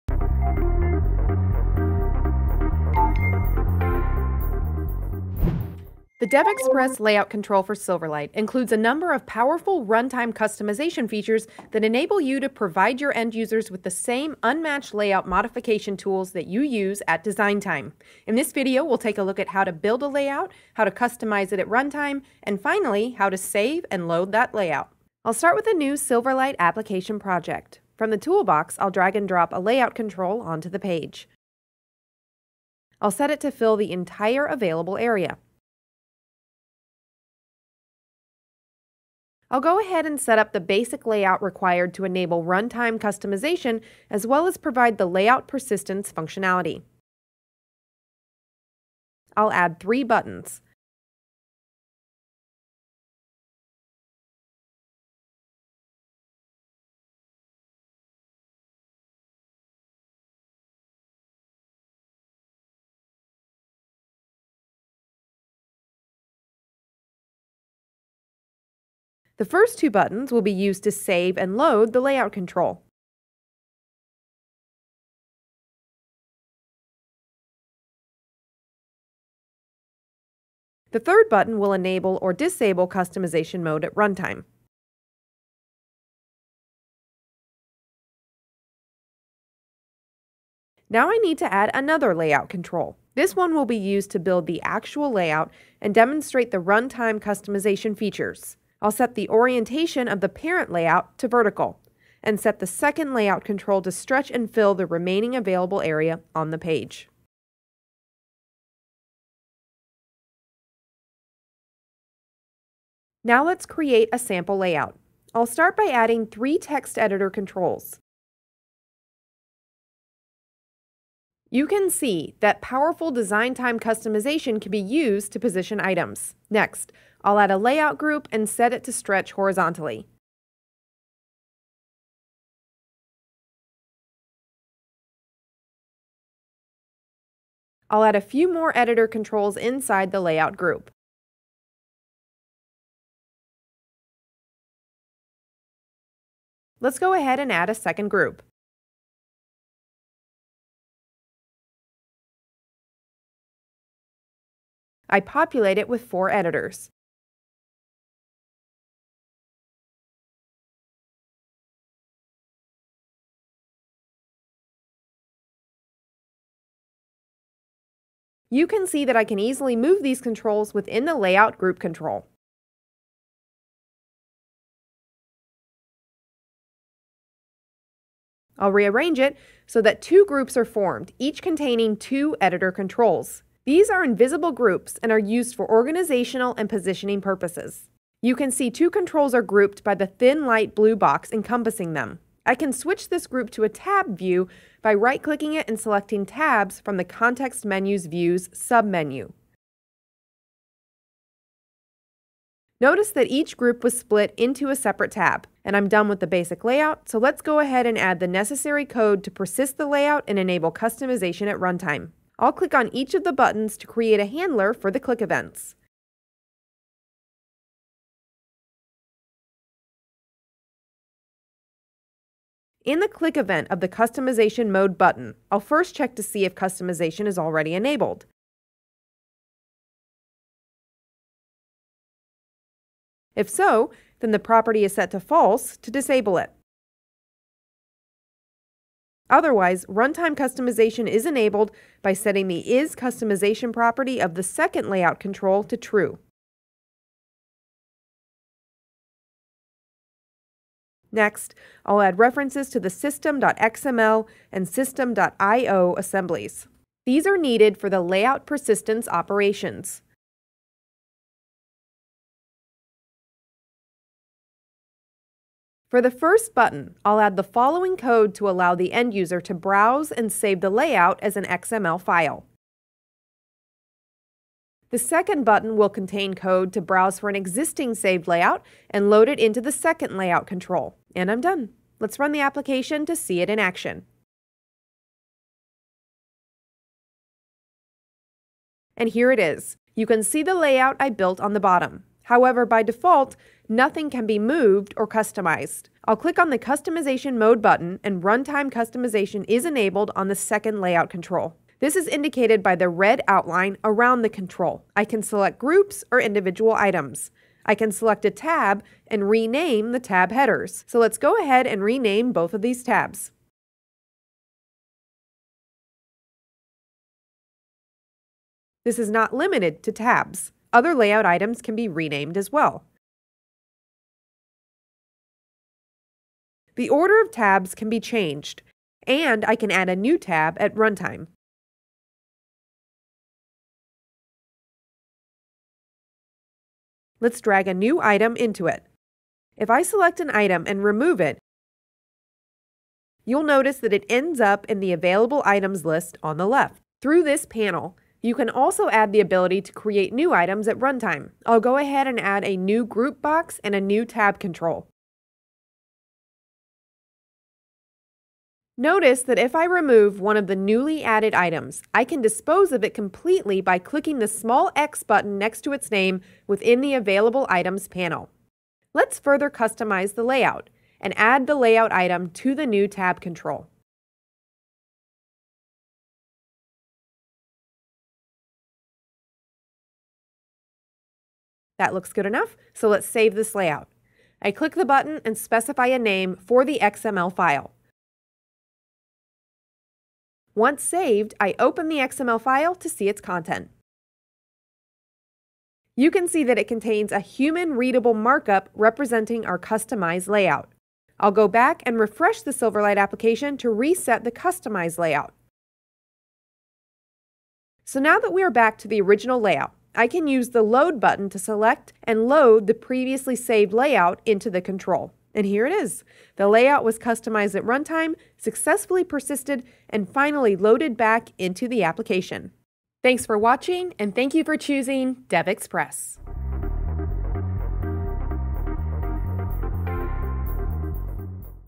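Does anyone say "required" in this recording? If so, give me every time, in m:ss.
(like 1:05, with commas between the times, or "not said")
0:41.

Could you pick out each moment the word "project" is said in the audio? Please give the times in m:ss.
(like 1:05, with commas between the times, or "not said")
0:27.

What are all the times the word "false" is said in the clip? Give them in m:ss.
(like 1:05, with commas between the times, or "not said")
3:55.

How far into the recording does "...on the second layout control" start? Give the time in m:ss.
5:00.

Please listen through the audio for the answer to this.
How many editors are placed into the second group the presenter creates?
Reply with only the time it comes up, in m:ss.
2:36.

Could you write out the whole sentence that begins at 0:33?
I'll set it to fill the entire available area.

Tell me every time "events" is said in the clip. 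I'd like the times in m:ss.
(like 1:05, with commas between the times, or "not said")
3:35, 3:43.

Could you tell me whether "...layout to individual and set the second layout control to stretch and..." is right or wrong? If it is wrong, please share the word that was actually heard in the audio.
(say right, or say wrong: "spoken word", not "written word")
wrong: "vertical", not "individual".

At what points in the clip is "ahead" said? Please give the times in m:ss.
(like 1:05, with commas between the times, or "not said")
0:39, 2:27, 3:27, 5:11, 5:51.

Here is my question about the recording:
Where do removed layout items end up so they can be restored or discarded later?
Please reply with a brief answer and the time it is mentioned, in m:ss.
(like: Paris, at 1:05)
Available Items list, at 5:44.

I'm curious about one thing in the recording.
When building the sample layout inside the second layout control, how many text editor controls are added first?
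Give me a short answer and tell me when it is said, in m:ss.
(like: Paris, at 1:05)
3, at 1:56.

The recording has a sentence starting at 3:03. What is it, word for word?
These are invisible groups and are used for organizational and positioning purposes.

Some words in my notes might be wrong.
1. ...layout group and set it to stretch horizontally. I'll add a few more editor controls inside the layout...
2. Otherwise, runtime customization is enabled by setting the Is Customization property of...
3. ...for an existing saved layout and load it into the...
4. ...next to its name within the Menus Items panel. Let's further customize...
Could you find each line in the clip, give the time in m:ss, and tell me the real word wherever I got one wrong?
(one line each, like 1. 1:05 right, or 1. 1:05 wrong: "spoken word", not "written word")
1. 2:07 right
2. 3:59 right
3. 4:37 right
4. 6:05 wrong: "Available", not "Menus".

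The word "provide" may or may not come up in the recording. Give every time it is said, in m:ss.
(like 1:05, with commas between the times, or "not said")
0:12, 0:44.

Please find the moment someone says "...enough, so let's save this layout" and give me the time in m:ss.
6:22.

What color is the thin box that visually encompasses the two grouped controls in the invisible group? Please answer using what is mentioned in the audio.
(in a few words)
Light blue.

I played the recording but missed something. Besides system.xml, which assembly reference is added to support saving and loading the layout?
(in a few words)
system.io.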